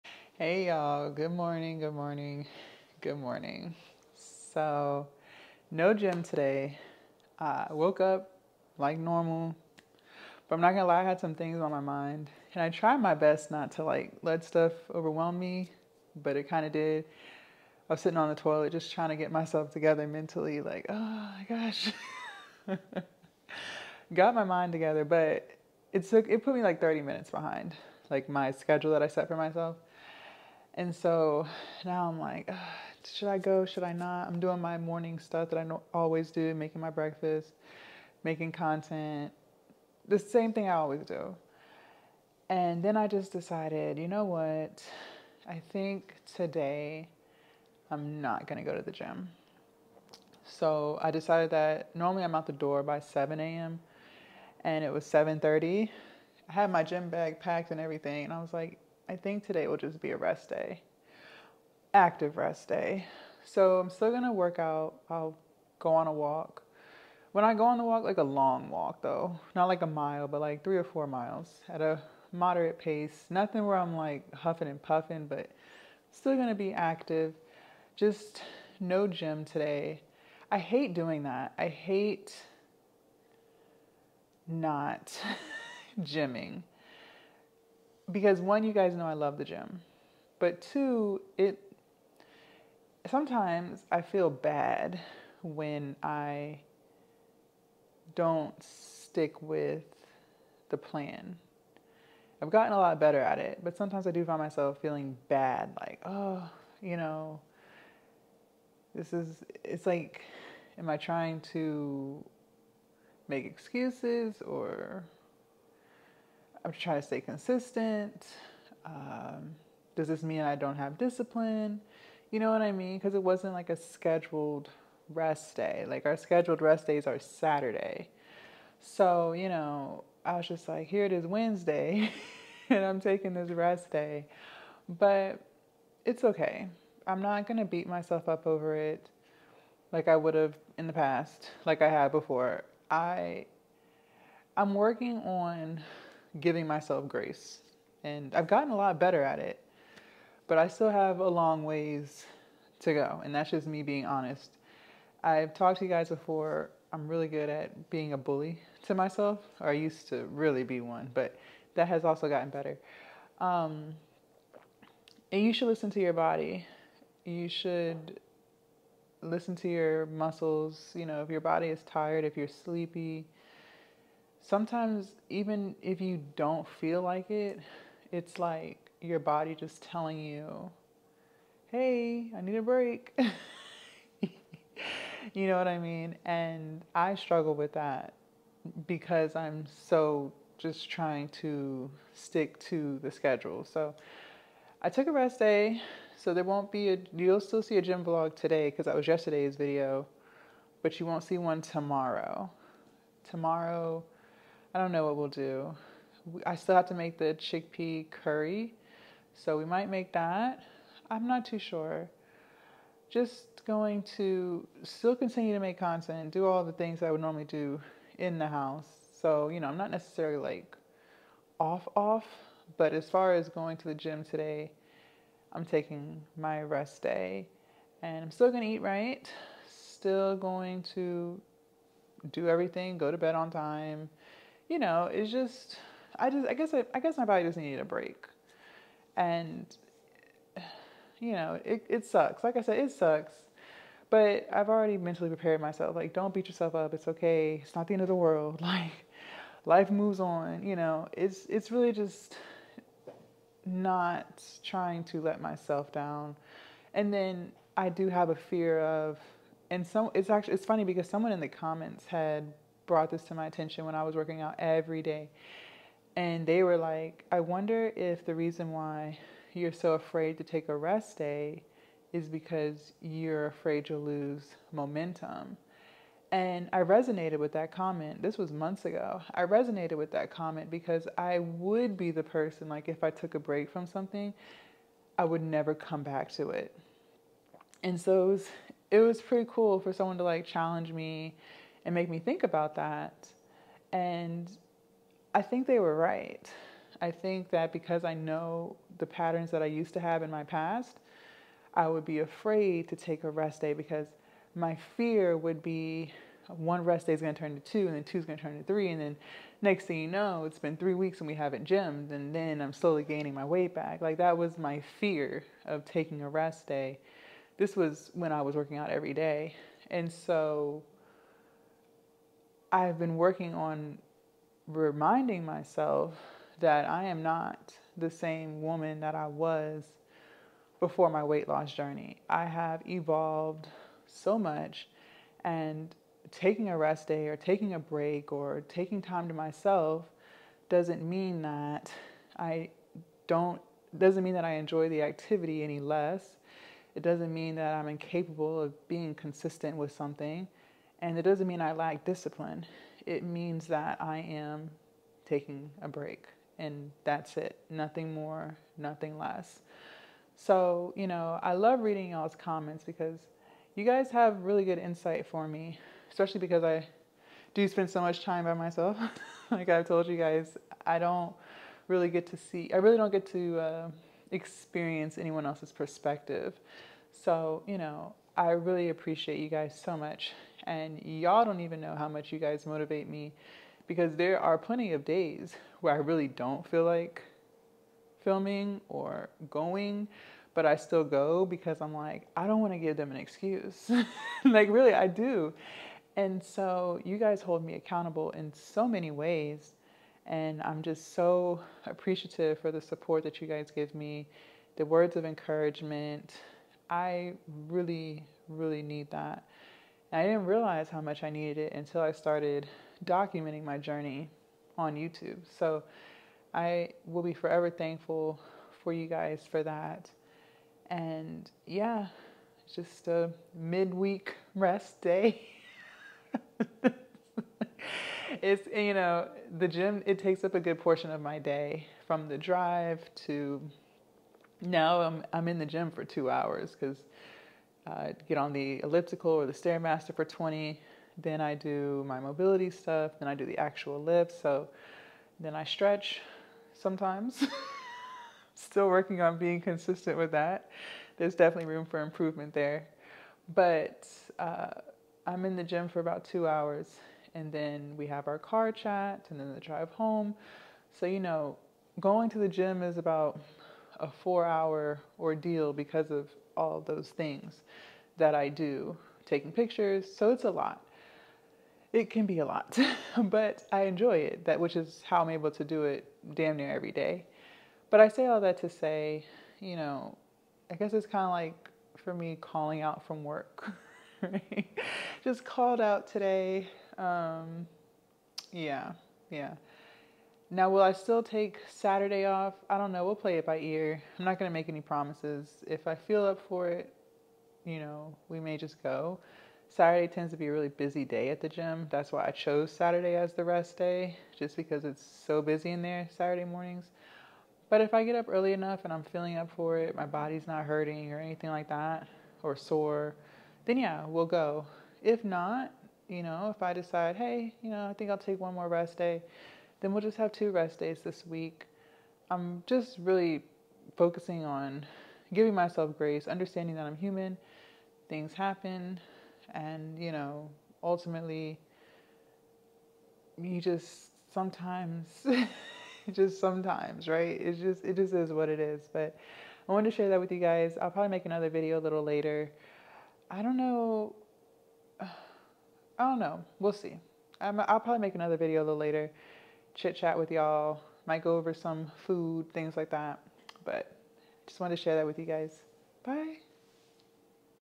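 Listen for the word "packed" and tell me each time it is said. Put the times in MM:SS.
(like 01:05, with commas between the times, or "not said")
00:57.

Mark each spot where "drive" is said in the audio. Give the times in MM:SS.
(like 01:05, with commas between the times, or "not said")
07:12, 07:39.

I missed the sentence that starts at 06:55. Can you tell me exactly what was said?
So I will be forever thankful for you guys for that.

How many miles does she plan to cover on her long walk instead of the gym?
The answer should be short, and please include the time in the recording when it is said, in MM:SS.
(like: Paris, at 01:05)
3 or 4, at 01:10.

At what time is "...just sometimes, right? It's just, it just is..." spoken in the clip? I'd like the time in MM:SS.
08:56.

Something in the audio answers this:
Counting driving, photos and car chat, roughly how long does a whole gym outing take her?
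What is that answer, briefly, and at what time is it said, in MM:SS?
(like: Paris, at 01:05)
4 hours, at 07:44.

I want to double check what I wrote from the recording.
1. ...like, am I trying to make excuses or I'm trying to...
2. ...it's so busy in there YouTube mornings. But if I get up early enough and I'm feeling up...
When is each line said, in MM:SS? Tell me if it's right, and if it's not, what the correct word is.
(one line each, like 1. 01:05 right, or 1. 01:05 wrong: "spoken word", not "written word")
1. 01:49 right
2. 08:24 wrong: "Saturday", not "YouTube".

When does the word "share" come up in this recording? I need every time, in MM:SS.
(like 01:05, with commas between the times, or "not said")
08:59, 09:14.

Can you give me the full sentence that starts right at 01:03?
So I'm still gonna work out.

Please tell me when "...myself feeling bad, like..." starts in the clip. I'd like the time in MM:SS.
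01:44.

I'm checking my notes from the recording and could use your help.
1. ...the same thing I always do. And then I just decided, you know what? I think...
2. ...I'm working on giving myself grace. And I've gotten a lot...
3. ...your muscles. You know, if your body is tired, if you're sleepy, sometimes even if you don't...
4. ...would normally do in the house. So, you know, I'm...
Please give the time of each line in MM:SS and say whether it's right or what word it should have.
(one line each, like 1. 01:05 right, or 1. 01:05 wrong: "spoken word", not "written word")
1. 00:40 right
2. 02:24 right
3. 02:49 right
4. 03:37 right.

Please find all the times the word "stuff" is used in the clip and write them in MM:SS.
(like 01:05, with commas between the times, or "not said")
00:14, 00:35, 07:22.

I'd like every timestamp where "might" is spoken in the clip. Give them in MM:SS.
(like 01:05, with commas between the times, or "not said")
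03:29, 09:11.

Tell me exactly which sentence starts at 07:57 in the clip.
But I say all that to say, you know, I guess it's kind of like for me calling out from work.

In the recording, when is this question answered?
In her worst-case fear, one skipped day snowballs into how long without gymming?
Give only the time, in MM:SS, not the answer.
05:10.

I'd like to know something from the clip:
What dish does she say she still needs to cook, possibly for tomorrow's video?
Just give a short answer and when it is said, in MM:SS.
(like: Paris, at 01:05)
Chickpea curry, at 03:27.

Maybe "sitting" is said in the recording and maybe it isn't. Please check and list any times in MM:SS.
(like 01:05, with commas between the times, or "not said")
00:18.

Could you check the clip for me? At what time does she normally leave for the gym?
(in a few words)
7 a.m.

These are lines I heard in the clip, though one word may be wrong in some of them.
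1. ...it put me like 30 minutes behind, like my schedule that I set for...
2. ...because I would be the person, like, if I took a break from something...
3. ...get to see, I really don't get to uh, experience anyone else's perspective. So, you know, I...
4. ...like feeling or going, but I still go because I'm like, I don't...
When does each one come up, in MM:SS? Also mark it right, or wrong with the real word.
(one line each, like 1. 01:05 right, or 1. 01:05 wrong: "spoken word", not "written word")
1. 00:26 right
2. 04:40 right
3. 06:12 right
4. 06:26 wrong: "filming", not "feeling".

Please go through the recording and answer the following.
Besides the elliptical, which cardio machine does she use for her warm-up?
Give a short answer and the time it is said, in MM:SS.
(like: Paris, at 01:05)
Stairmaster, at 07:19.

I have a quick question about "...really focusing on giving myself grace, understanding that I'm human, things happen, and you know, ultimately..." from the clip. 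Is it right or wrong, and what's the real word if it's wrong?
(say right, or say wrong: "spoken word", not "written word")
right.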